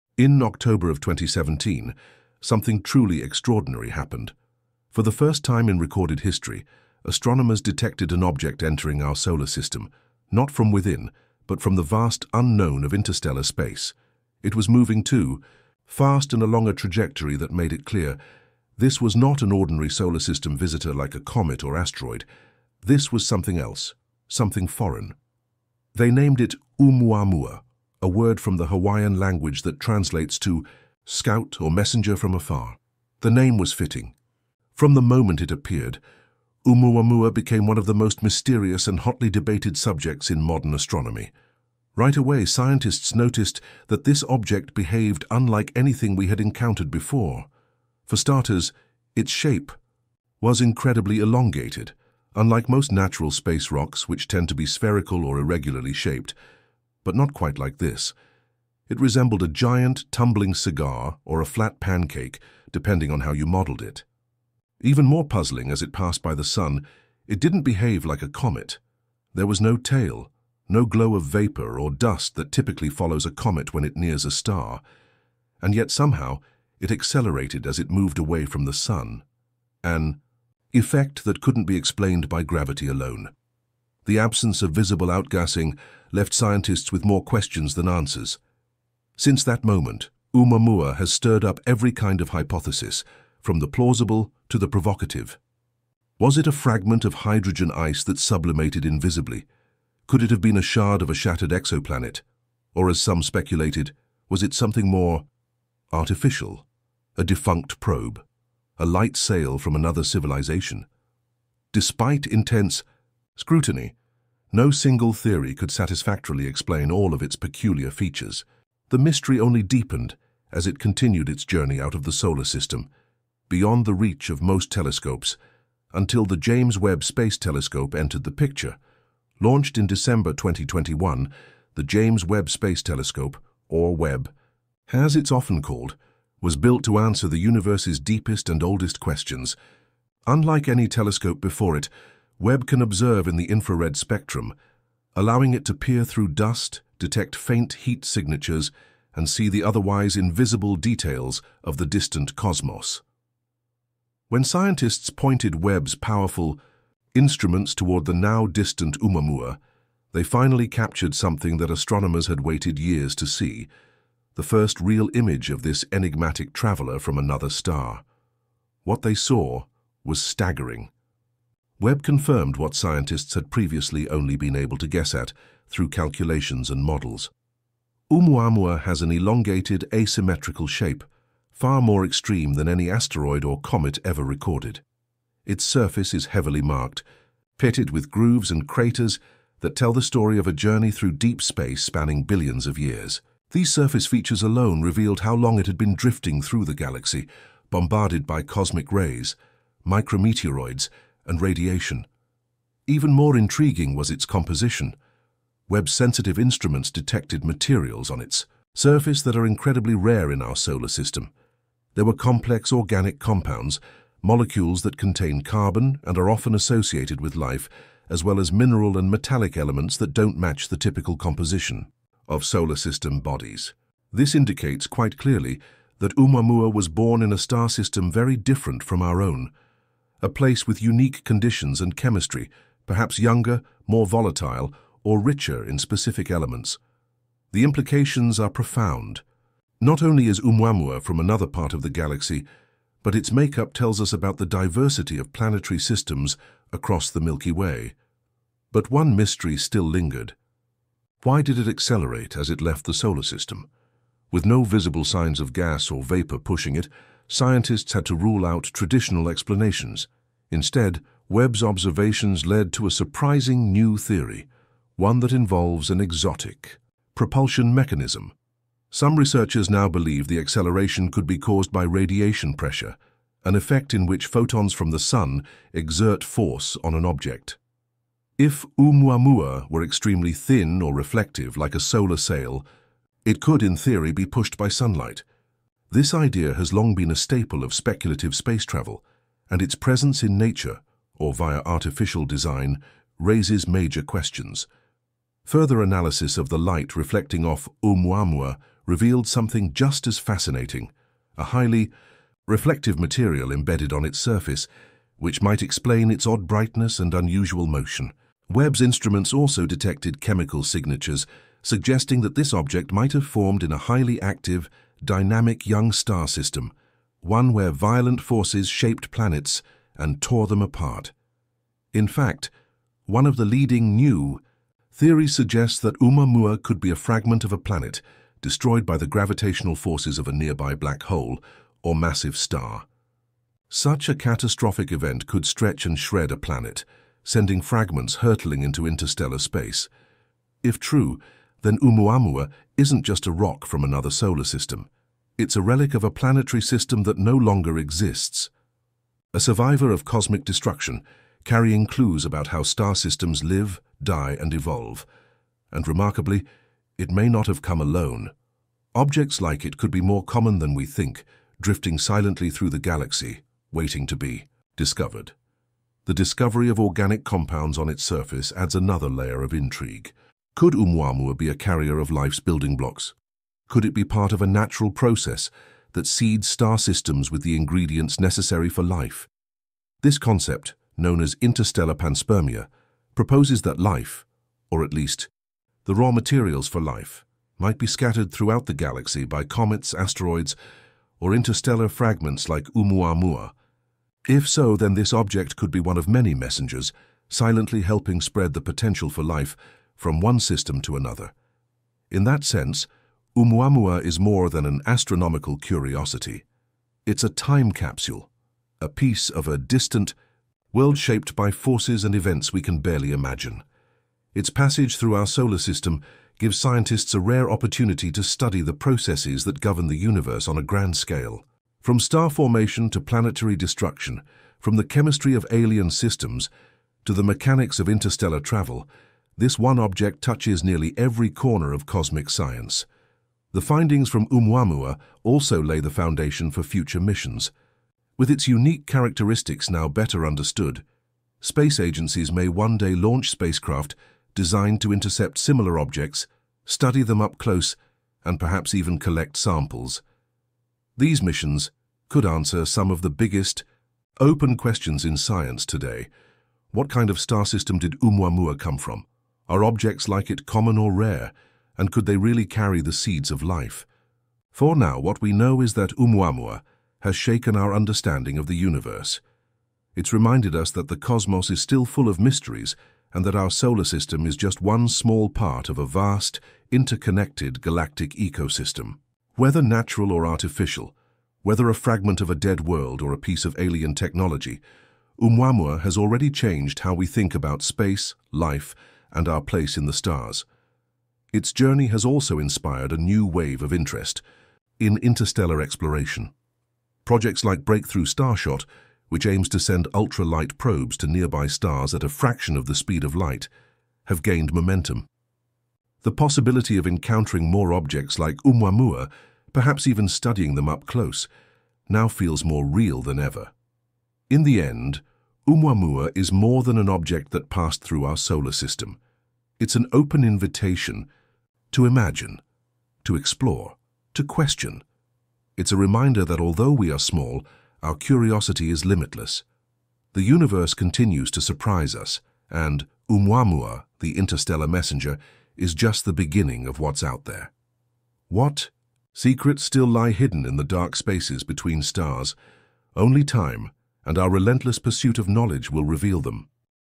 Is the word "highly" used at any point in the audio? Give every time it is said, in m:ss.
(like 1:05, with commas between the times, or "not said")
5:01, 5:13.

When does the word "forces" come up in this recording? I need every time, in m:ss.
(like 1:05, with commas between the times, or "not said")
4:36, 5:18, 5:29, 6:51.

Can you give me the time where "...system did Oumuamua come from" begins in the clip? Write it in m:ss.
7:37.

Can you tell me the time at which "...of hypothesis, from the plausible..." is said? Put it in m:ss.
1:32.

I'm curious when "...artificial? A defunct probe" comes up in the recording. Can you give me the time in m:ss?
1:45.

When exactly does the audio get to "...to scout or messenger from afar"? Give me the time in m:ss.
0:30.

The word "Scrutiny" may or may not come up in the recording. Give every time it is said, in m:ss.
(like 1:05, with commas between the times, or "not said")
1:53.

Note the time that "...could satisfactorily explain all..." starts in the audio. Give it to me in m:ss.
1:55.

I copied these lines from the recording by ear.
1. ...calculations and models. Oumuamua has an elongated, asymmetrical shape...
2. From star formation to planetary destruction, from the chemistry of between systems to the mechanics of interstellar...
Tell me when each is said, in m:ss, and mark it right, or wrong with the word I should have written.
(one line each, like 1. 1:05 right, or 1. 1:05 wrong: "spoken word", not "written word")
1. 2:55 right
2. 7:01 wrong: "alien", not "between".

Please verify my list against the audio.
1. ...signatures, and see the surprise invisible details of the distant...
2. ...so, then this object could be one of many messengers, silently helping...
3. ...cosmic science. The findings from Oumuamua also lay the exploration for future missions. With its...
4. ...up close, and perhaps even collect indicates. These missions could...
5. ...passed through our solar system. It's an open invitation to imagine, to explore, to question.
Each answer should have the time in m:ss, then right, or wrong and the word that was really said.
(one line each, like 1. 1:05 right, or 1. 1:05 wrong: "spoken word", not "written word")
1. 2:28 wrong: "otherwise", not "surprise"
2. 6:34 right
3. 7:11 wrong: "foundation", not "exploration"
4. 7:27 wrong: "samples", not "indicates"
5. 8:37 right.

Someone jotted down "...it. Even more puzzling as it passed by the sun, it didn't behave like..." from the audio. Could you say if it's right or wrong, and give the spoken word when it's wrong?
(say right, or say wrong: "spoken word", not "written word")
right.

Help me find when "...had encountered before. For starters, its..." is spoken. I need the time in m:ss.
0:46.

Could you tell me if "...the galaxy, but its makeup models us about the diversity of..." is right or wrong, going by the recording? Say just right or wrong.
wrong.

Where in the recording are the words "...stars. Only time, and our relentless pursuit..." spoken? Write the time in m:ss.
9:01.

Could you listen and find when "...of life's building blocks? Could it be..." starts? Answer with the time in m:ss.
6:11.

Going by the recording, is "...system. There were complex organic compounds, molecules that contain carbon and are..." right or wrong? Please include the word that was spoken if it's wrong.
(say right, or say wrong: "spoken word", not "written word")
right.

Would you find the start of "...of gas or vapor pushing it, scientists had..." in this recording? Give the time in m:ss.
4:15.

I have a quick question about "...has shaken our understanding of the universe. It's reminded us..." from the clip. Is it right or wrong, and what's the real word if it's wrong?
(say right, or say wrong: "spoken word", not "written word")
right.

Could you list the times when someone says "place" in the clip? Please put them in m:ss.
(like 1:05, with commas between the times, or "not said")
3:50, 8:09.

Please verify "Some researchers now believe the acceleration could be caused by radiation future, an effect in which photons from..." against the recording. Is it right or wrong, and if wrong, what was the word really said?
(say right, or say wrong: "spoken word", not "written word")
wrong: "pressure", not "future".